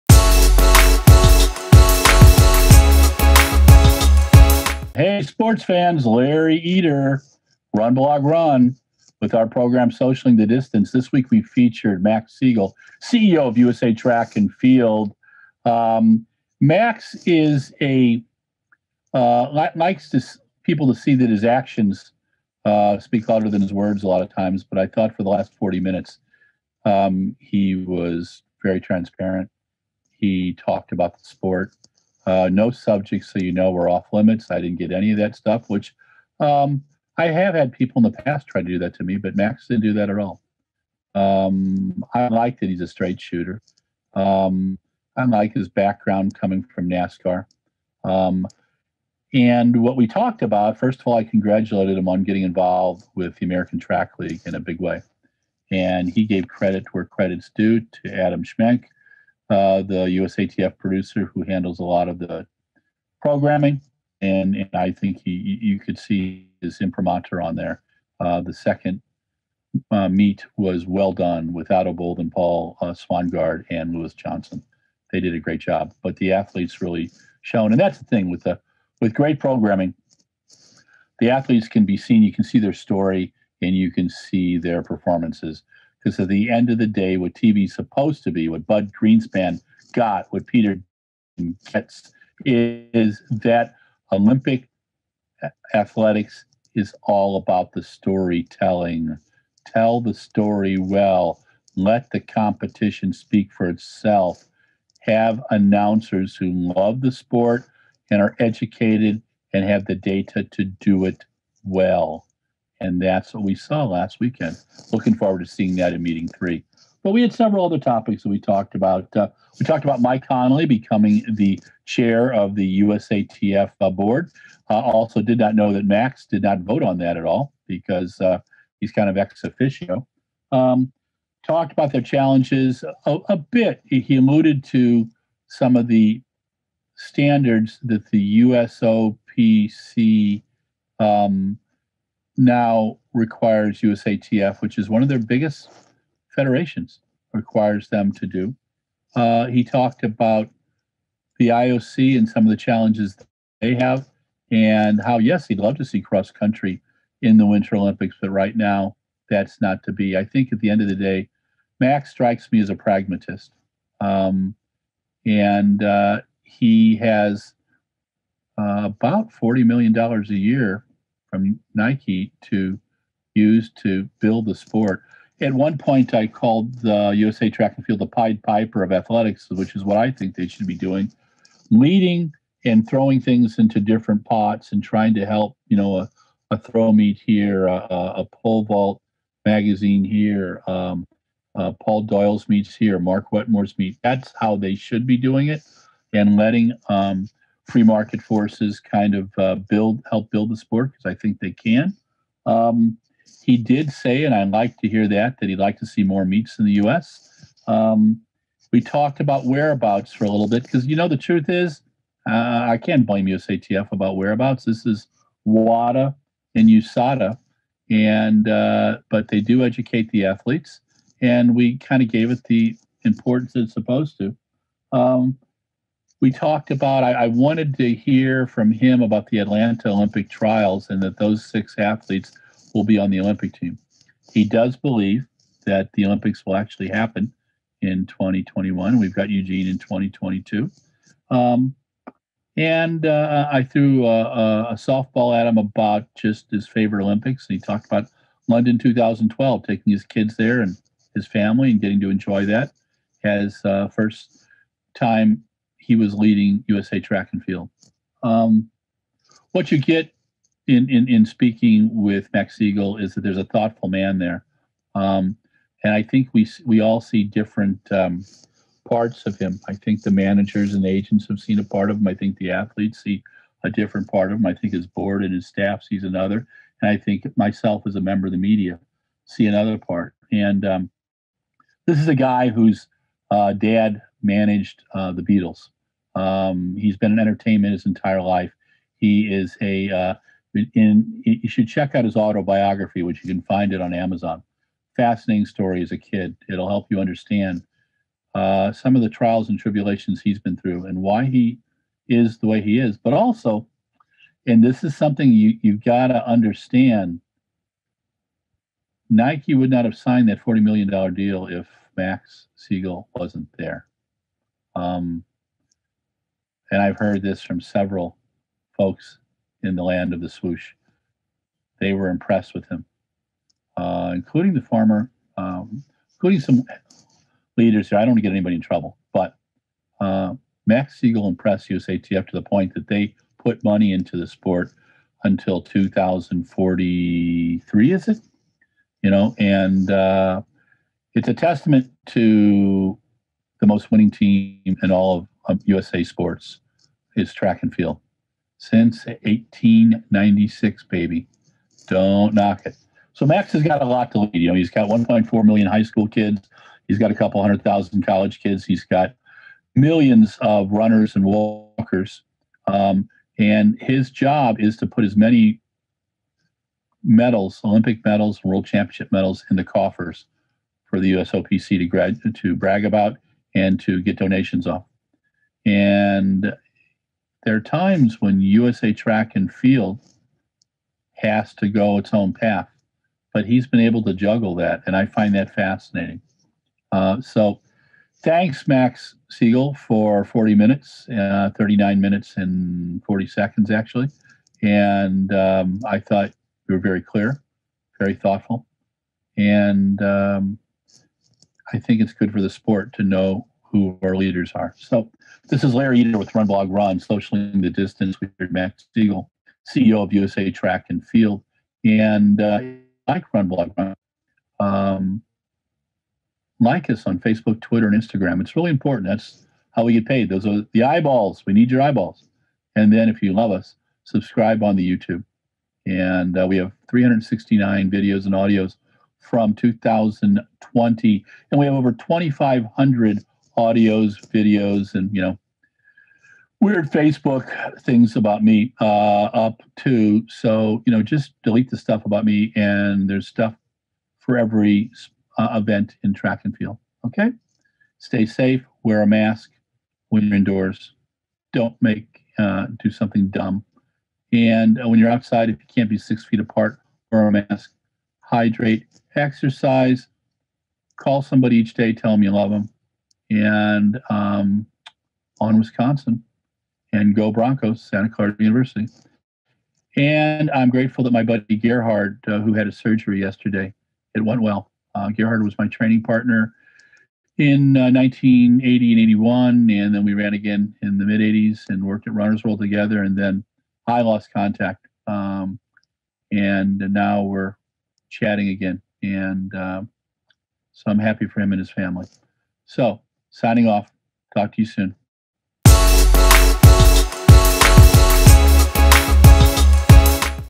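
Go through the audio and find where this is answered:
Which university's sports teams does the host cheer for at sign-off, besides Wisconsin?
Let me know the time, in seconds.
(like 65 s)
467 s.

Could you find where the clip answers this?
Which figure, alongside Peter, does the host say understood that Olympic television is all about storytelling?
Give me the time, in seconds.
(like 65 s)
88 s.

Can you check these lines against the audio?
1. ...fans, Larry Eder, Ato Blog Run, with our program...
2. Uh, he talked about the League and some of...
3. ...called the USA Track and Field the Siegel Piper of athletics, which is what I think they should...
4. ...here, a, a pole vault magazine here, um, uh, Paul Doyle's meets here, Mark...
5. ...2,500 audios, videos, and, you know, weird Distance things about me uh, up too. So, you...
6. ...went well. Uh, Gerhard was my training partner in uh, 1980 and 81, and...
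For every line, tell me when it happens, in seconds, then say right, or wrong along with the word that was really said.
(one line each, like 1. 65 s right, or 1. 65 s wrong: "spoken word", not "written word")
1. 5 s wrong: "Run", not "Ato"
2. 149 s wrong: "IOC", not "League"
3. 176 s wrong: "Pied", not "Siegel"
4. 187 s right
5. 431 s wrong: "Facebook", not "Distance"
6. 474 s right.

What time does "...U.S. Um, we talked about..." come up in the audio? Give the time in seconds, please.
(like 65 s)
206 s.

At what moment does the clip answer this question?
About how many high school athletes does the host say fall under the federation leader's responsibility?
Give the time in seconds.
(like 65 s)
354 s.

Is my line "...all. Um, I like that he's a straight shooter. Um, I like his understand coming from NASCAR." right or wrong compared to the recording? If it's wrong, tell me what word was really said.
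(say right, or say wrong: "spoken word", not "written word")
wrong: "background", not "understand".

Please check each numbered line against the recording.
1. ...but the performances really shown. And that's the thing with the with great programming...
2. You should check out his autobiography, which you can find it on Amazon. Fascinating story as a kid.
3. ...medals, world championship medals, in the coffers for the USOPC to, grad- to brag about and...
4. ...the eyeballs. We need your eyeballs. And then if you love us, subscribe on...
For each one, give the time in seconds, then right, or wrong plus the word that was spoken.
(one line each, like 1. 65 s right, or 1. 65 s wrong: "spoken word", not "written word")
1. 76 s wrong: "athletes", not "performances"
2. 291 s right
3. 368 s right
4. 420 s right.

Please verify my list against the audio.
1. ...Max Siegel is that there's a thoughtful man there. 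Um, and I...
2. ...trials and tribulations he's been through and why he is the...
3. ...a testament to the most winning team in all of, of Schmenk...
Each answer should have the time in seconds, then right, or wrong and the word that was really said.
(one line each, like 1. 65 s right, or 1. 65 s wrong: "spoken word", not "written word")
1. 262 s right
2. 299 s right
3. 341 s wrong: "USA", not "Schmenk".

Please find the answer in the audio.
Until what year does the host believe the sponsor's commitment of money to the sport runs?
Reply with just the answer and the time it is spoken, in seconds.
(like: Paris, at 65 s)
2043, at 335 s.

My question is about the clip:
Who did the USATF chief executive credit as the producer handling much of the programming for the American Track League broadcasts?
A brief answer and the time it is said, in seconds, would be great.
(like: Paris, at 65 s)
Adam Schmenk, at 58 s.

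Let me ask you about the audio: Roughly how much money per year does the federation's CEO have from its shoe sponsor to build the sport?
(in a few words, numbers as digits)
$40 million.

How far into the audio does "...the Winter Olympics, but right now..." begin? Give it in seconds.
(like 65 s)
157 s.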